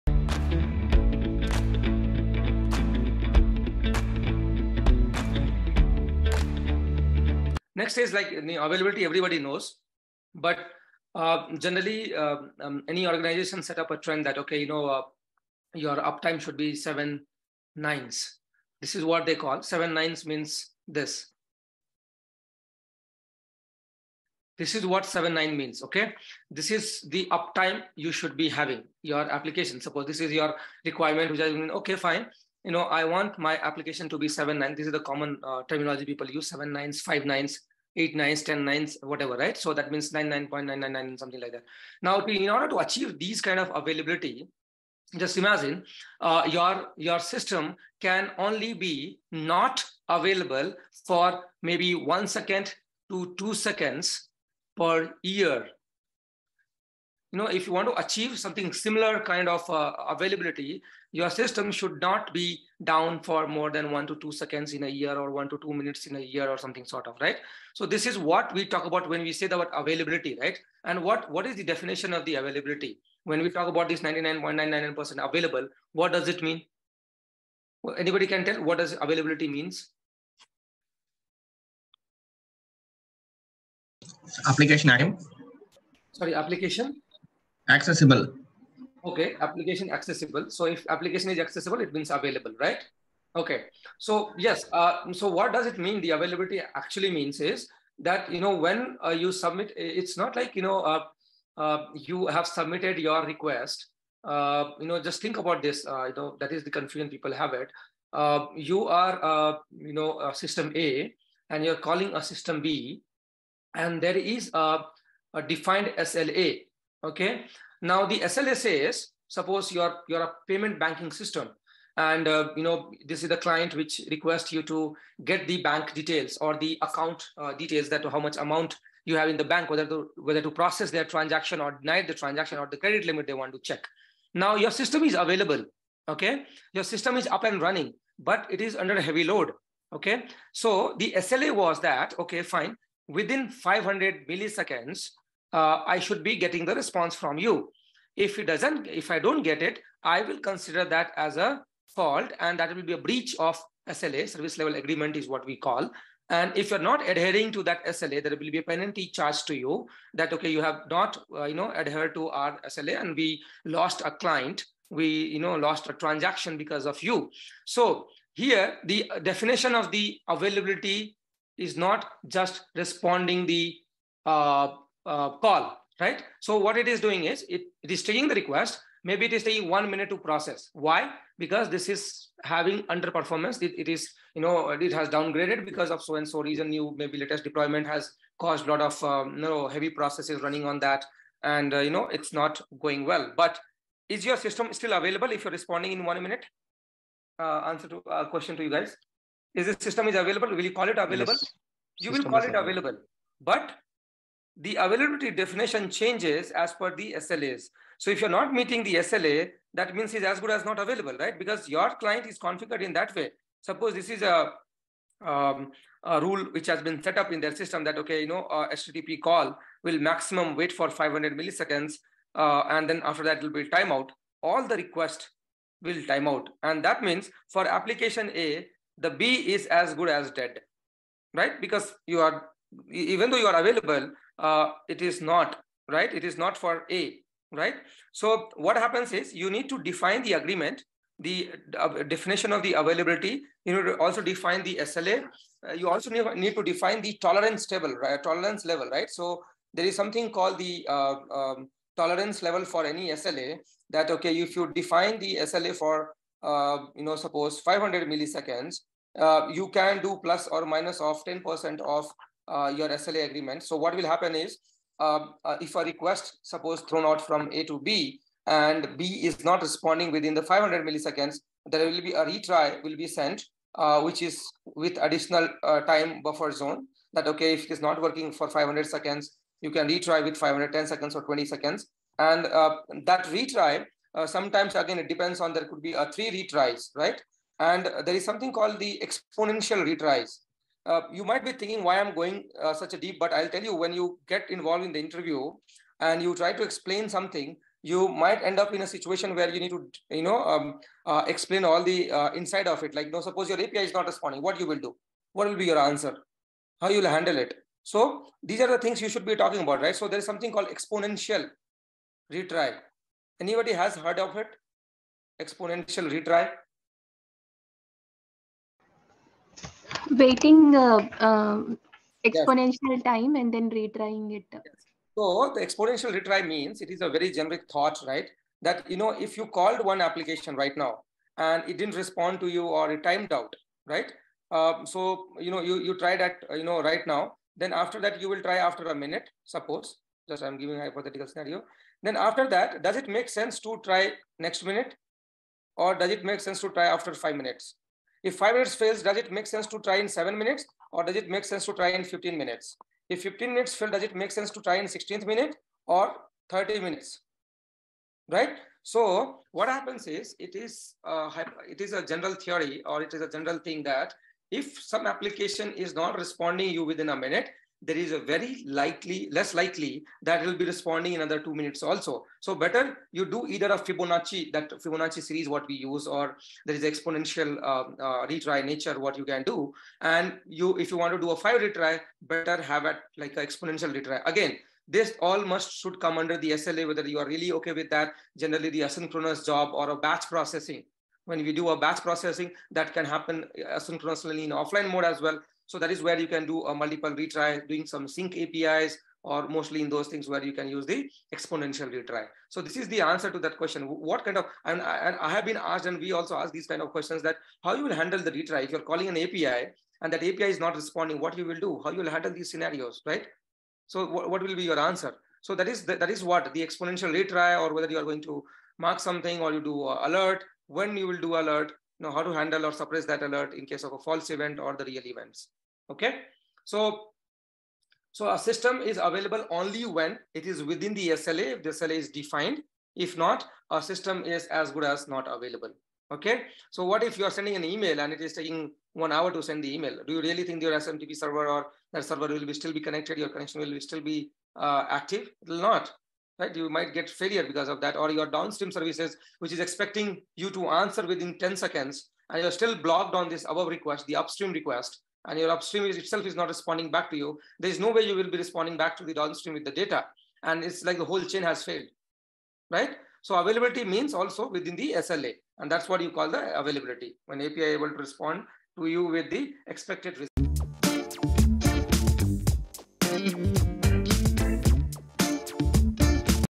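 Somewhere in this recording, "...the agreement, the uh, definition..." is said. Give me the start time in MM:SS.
04:00.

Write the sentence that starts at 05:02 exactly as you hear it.
Like, no, suppose your API is not responding, what you will do?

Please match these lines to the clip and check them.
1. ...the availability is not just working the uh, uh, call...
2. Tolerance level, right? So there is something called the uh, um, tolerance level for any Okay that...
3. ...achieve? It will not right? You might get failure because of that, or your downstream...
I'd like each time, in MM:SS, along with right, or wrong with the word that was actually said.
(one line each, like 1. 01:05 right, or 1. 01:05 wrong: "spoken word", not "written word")
1. 02:49 wrong: "responding", not "working"
2. 04:08 wrong: "SLA", not "Okay"
3. 07:24 wrong: "active", not "achieve".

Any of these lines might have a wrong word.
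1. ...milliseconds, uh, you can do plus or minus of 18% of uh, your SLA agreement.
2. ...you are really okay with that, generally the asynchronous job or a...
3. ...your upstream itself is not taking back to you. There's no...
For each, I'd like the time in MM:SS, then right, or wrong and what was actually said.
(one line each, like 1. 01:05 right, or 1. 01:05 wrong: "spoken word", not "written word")
1. 04:18 wrong: "10", not "18"
2. 06:27 right
3. 07:35 wrong: "responding", not "taking".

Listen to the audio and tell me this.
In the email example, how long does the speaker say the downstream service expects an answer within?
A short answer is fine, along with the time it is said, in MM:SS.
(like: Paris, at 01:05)
10 seconds, at 07:31.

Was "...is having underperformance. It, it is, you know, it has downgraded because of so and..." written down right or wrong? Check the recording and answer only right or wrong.
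right.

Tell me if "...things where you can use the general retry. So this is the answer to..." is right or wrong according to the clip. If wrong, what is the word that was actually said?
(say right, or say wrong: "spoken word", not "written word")
wrong: "exponential", not "general".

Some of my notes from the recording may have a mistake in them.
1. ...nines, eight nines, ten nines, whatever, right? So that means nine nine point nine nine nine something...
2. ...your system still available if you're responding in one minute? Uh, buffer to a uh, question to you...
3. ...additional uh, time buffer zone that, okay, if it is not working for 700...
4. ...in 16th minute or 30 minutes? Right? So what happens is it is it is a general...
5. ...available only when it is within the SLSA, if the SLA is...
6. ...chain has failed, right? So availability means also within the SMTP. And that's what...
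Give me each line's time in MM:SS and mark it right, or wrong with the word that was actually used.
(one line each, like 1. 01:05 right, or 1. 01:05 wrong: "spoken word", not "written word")
1. 00:37 right
2. 03:14 wrong: "answer", not "buffer"
3. 04:35 wrong: "500", not "700"
4. 05:54 right
5. 07:09 wrong: "SLA", not "SLSA"
6. 07:41 wrong: "SLA", not "SMTP".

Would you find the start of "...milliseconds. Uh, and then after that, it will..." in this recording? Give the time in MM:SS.
03:41.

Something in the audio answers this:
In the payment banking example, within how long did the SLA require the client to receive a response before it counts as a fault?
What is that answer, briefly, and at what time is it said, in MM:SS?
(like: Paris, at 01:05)
500 milliseconds, at 02:23.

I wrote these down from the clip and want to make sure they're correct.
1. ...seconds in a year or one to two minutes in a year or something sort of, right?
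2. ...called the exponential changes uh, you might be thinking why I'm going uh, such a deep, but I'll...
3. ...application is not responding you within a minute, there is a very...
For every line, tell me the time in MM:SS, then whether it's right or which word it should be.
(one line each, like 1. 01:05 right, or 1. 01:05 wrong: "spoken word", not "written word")
1. 01:04 right
2. 04:48 wrong: "retries", not "changes"
3. 06:05 right.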